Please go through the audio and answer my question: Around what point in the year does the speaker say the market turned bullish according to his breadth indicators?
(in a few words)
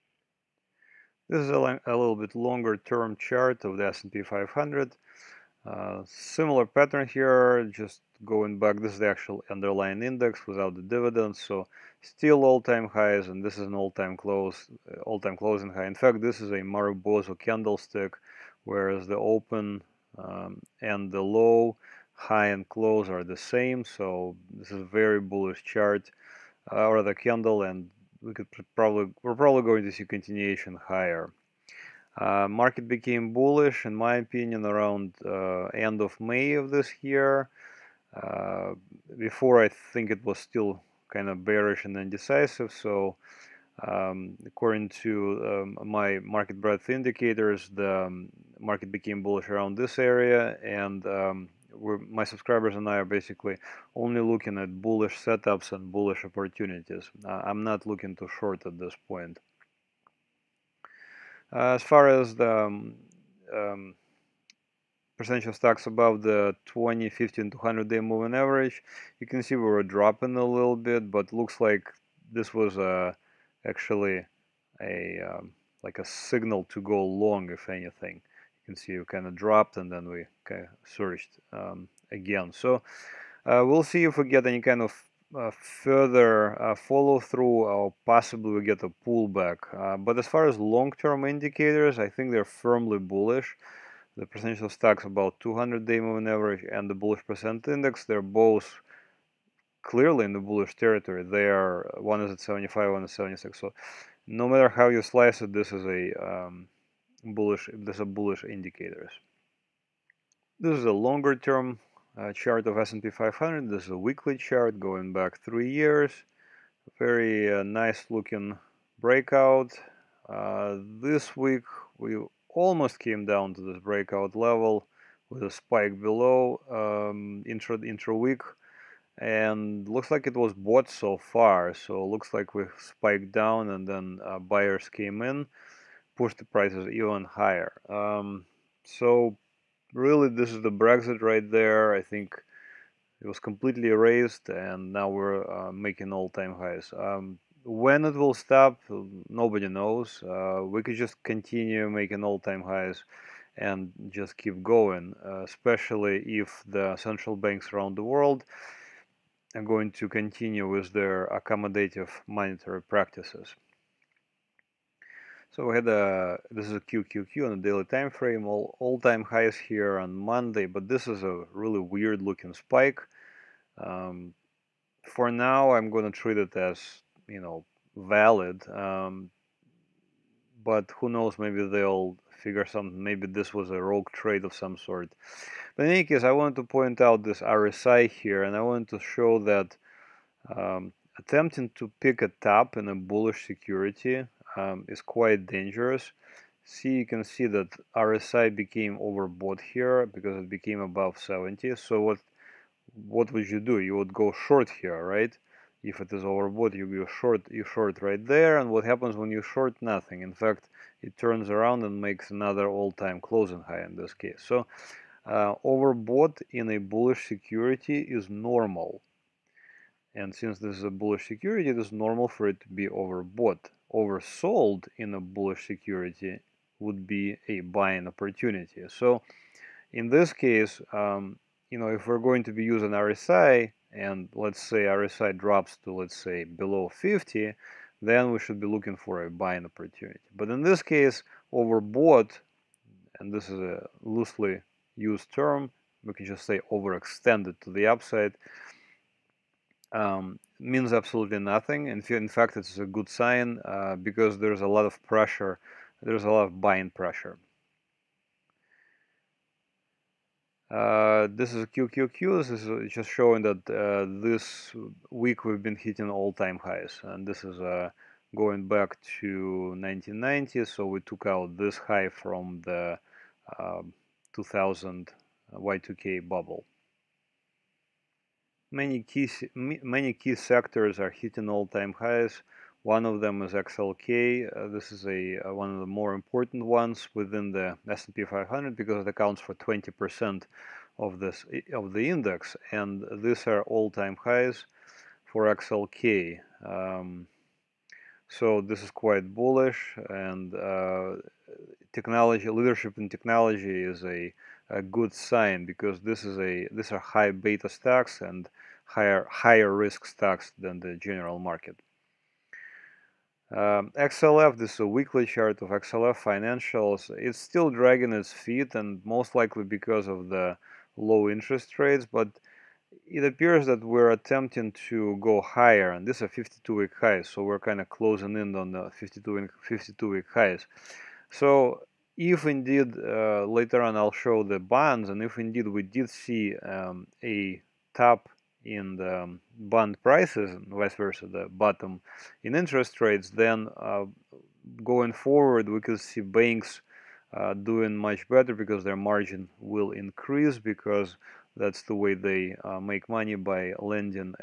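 End of May.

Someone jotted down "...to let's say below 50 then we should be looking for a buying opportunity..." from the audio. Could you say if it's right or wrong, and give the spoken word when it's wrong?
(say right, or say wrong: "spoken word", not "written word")
right.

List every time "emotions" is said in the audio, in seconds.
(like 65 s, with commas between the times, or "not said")
not said.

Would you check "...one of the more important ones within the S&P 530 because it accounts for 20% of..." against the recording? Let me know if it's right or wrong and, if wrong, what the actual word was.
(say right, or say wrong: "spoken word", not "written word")
wrong: "500", not "530".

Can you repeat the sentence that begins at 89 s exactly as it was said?
Uh, but as far as long term indicators, I think they're firmly bullish.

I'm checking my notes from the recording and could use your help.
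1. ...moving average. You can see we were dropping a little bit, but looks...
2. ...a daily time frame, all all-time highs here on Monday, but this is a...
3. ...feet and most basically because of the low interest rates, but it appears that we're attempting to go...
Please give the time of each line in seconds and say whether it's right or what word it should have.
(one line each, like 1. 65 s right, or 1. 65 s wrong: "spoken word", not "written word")
1. 67 s right
2. 167 s right
3. 318 s wrong: "likely", not "basically".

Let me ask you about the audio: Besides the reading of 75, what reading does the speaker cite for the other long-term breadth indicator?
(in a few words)
76.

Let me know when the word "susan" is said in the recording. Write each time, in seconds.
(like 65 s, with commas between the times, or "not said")
not said.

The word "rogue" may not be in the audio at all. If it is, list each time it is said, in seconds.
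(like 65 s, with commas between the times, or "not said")
183 s.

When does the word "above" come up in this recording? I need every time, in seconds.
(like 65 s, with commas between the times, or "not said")
65 s, 200 s.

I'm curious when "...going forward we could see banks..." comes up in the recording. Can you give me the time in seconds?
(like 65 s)
344 s.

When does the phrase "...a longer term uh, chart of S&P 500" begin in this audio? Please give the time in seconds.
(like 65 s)
110 s.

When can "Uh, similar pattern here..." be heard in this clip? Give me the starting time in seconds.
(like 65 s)
5 s.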